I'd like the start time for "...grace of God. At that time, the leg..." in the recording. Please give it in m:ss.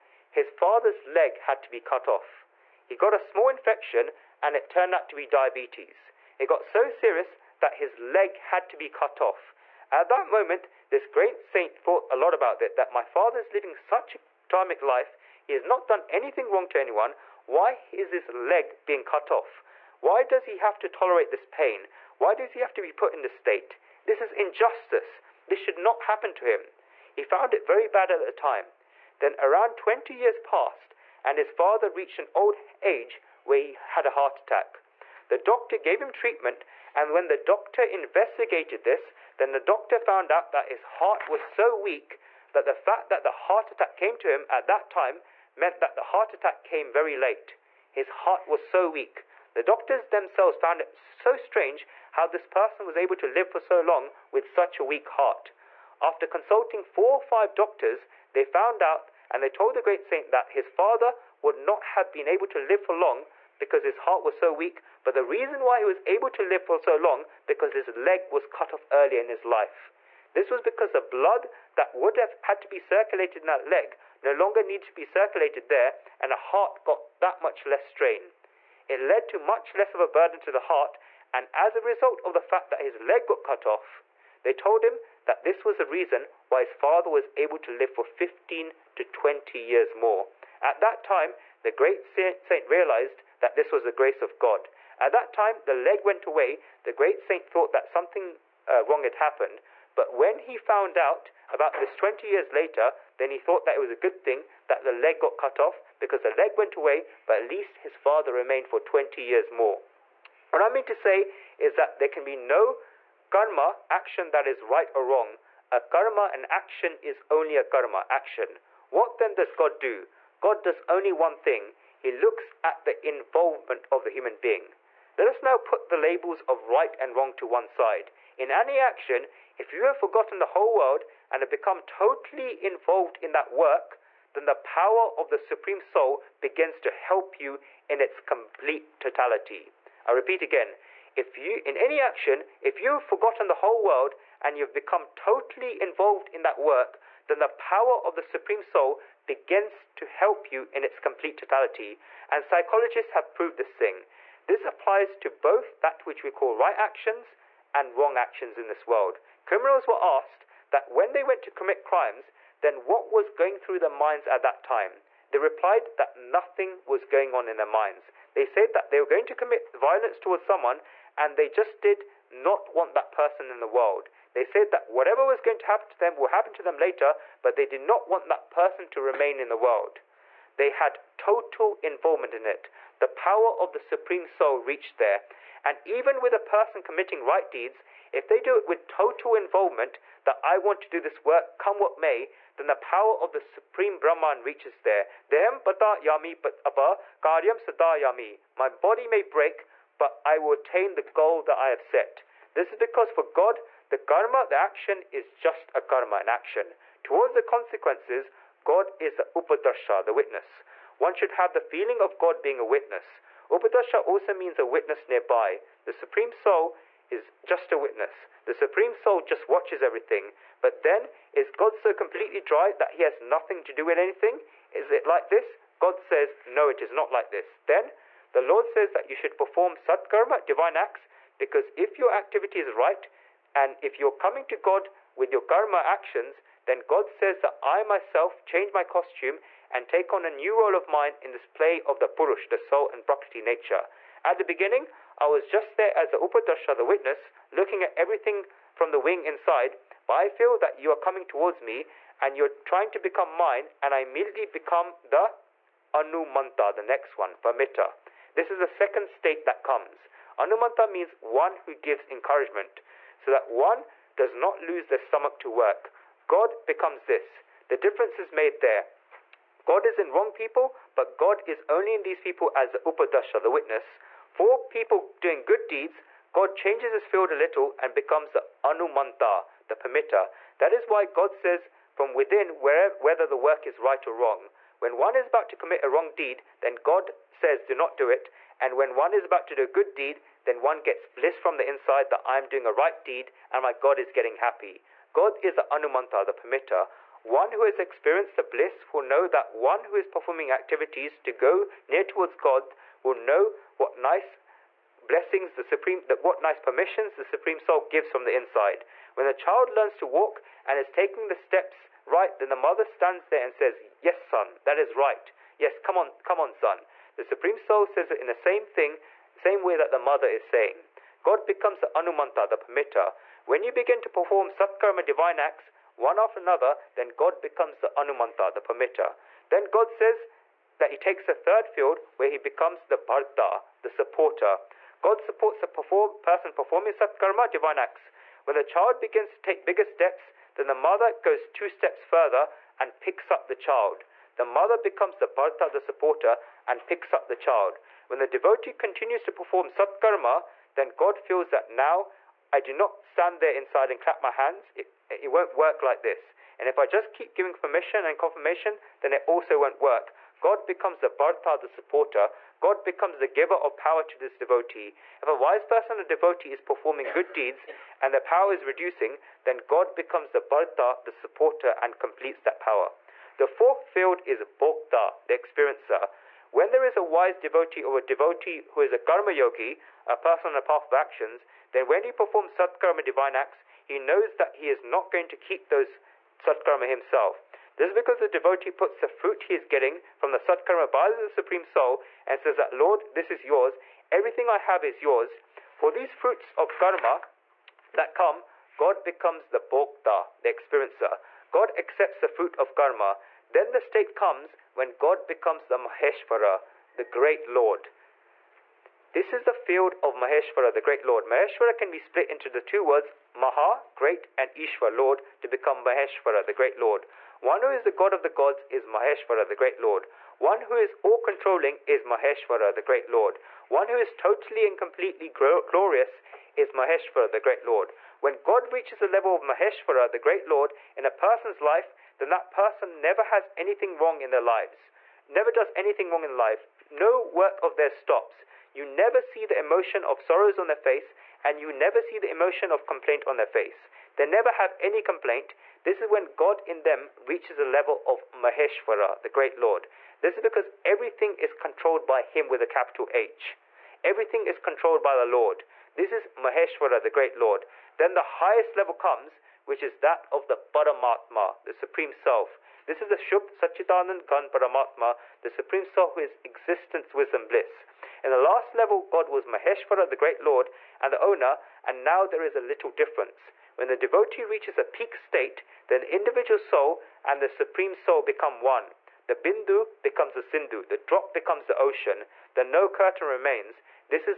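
1:33.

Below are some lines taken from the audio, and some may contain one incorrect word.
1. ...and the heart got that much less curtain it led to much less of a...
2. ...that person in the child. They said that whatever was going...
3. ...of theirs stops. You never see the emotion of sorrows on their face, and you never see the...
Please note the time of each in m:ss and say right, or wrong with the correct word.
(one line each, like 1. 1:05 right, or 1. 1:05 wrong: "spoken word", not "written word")
1. 1:16 wrong: "strain", not "curtain"
2. 2:52 wrong: "world", not "child"
3. 7:17 right.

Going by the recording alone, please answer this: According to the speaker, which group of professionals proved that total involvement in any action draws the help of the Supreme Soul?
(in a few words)
Psychologists.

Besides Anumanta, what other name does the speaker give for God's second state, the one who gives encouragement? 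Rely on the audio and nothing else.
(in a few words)
Pamita.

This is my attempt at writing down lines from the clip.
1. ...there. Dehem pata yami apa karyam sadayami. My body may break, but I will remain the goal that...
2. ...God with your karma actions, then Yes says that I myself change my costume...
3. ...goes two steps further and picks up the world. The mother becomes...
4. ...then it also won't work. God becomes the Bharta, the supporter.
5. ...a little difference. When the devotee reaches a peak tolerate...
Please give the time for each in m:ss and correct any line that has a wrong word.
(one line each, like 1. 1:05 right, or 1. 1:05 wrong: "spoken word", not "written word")
1. 3:14 wrong: "attain", not "remain"
2. 3:54 wrong: "God", not "Yes"
3. 5:41 wrong: "child", not "world"
4. 5:59 right
5. 7:52 wrong: "state", not "tolerate".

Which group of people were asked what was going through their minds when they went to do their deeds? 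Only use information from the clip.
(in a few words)
Criminals.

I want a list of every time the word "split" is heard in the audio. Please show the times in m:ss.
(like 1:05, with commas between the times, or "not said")
6:51.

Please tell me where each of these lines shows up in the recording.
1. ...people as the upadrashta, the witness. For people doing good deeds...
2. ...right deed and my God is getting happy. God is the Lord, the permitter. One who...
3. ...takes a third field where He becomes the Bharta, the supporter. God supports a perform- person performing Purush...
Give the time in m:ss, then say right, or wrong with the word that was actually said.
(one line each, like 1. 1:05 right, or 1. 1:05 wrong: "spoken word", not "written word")
1. 4:32 right
2. 4:52 wrong: "Anumanta", not "Lord"
3. 5:30 wrong: "Satkarma", not "Purush".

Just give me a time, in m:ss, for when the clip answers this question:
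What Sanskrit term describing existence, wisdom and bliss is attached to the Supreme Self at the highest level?
7:43.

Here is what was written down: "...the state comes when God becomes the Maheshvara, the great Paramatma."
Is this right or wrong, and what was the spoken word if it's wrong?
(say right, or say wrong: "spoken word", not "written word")
wrong: "Lord", not "Paramatma".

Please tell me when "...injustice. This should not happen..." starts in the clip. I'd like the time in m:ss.
0:24.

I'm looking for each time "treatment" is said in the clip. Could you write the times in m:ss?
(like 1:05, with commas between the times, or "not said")
0:36.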